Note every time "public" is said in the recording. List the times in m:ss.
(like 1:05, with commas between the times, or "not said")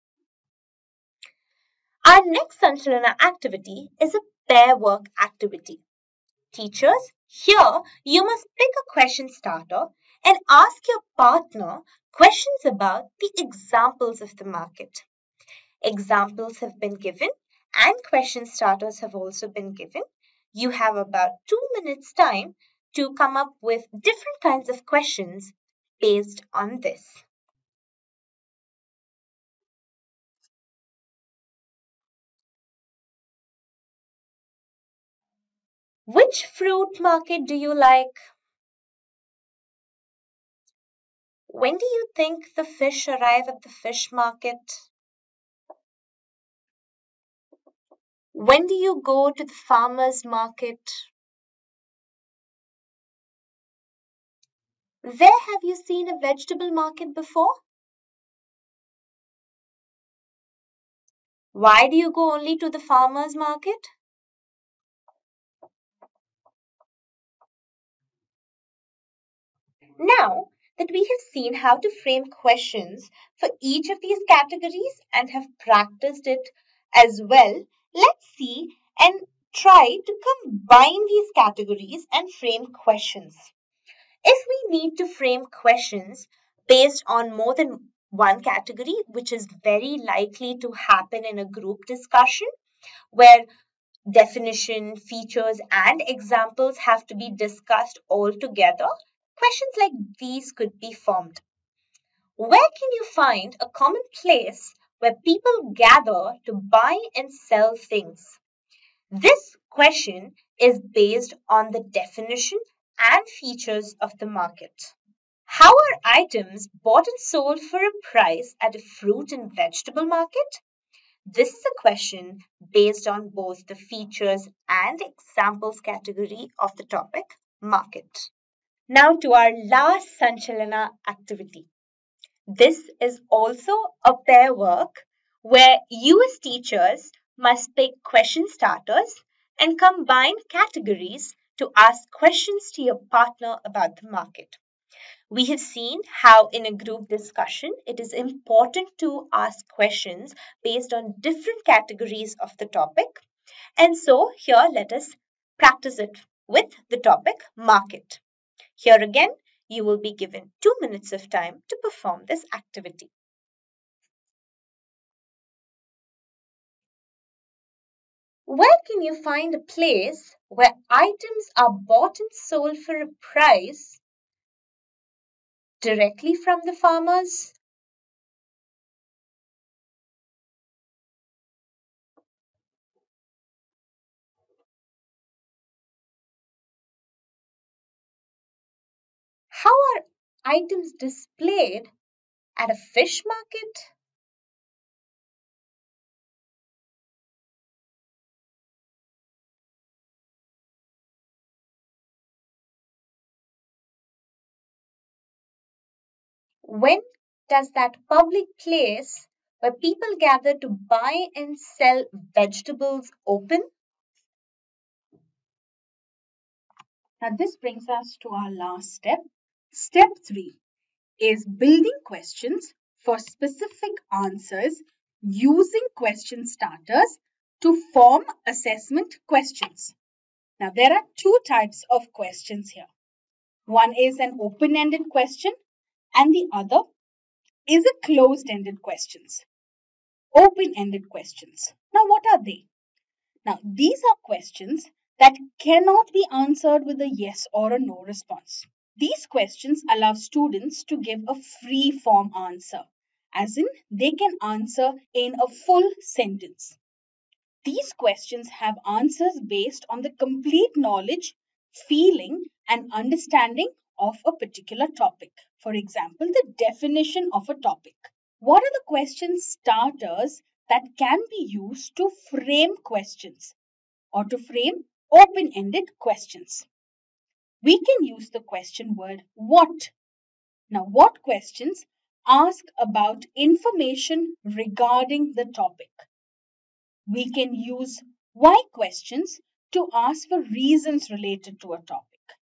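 3:28.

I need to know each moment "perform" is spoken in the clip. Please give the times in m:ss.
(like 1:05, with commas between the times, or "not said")
2:41.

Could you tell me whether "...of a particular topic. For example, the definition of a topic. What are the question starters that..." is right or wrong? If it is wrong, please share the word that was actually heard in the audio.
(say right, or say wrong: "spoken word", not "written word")
right.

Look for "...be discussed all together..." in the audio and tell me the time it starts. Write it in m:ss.
1:37.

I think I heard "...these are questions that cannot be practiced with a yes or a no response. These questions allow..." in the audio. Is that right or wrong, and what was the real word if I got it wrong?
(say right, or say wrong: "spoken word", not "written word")
wrong: "answered", not "practiced".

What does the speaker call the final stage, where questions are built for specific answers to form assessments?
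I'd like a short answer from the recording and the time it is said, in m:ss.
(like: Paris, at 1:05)
Step three, at 3:39.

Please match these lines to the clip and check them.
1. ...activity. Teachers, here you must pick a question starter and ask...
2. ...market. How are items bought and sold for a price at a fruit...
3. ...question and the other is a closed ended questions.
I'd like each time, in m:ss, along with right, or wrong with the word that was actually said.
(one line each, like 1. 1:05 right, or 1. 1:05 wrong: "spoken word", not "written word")
1. 0:05 right
2. 1:54 right
3. 3:55 right.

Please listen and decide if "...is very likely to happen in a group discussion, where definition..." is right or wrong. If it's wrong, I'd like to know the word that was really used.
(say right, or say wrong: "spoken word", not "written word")
right.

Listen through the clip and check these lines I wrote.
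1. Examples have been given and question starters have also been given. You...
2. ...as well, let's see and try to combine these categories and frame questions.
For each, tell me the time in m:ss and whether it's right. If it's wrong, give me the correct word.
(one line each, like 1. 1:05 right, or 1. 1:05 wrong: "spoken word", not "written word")
1. 0:15 right
2. 1:16 right.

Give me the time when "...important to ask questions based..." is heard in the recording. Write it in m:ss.
2:28.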